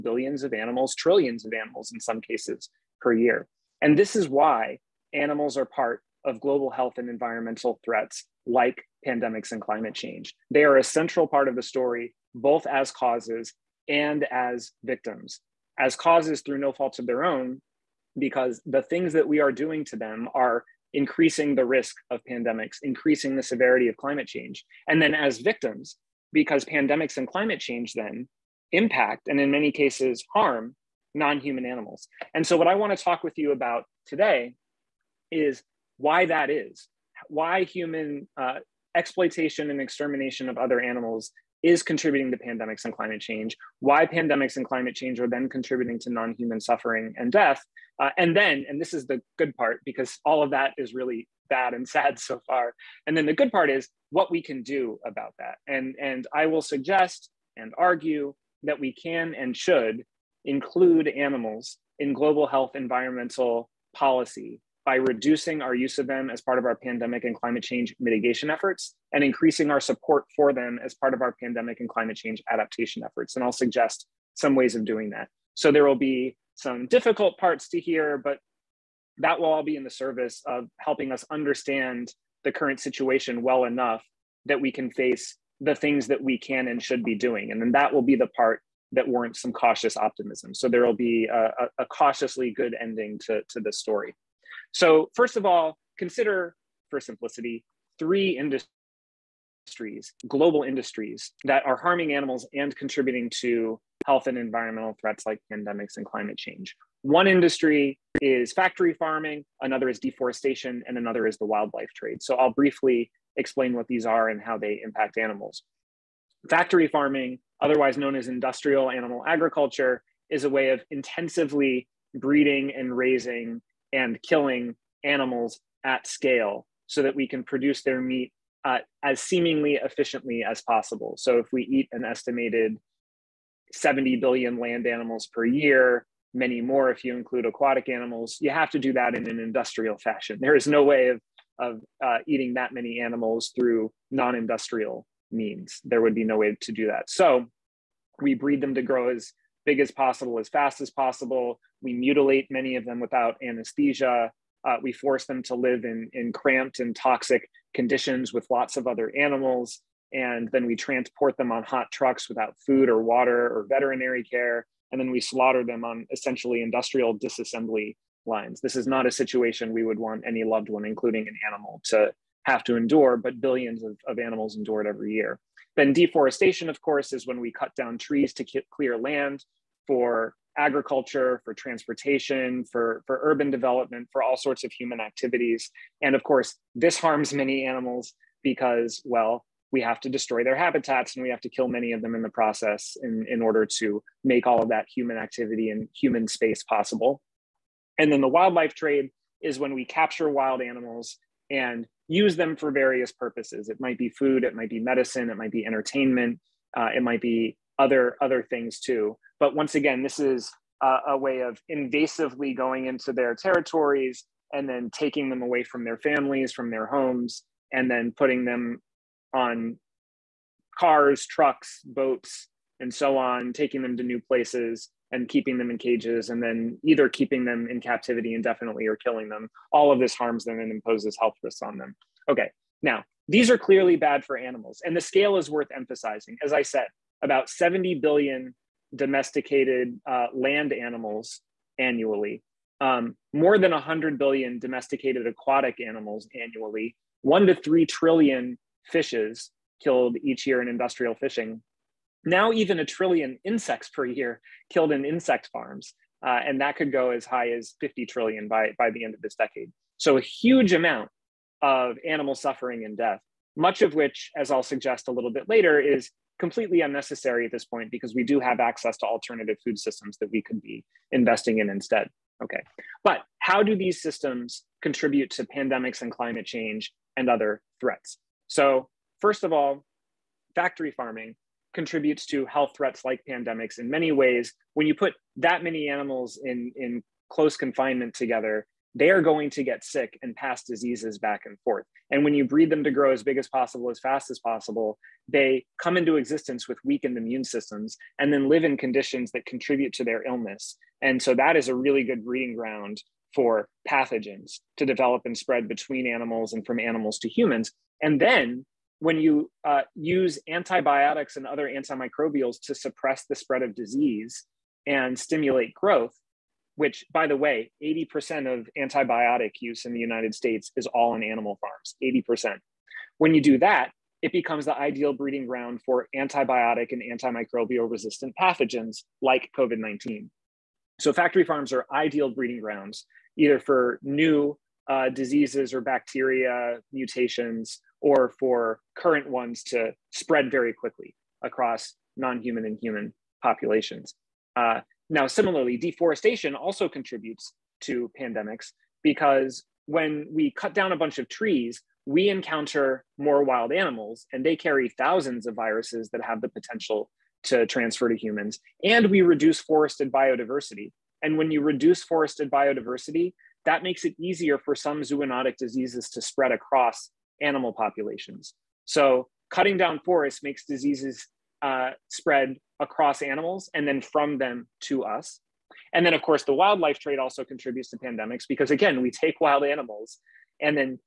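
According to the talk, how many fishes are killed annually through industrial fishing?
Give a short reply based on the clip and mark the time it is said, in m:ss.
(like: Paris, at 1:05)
1 to 3 trillion, at 4:07.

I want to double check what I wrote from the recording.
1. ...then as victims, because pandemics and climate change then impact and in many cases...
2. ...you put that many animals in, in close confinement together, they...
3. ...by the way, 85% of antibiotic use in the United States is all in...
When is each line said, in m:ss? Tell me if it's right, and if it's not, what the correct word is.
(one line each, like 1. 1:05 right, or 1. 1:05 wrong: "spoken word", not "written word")
1. 0:25 right
2. 4:44 right
3. 5:17 wrong: "80", not "85".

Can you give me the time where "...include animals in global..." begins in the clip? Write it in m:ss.
1:00.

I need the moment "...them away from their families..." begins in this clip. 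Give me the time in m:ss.
3:35.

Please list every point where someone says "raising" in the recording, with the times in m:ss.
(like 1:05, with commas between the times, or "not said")
2:02.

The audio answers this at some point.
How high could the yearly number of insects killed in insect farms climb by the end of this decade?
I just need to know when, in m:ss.
4:17.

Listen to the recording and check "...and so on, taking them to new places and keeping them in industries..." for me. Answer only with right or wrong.
wrong.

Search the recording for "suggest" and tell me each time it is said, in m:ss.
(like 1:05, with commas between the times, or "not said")
0:56, 1:13, 4:24.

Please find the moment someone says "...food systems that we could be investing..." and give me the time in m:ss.
4:29.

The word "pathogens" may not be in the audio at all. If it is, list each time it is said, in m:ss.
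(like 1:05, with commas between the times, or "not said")
5:03, 5:28.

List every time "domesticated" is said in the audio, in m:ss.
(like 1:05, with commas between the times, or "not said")
3:58, 4:04.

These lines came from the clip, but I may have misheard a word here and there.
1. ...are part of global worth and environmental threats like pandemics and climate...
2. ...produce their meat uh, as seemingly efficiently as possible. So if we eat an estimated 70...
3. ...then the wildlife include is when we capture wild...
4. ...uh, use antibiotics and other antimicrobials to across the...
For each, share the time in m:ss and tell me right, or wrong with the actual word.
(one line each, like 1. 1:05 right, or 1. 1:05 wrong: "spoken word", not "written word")
1. 0:05 wrong: "health", not "worth"
2. 2:07 right
3. 3:18 wrong: "trade", not "include"
4. 5:09 wrong: "suppress", not "across".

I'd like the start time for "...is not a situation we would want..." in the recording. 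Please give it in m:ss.
2:48.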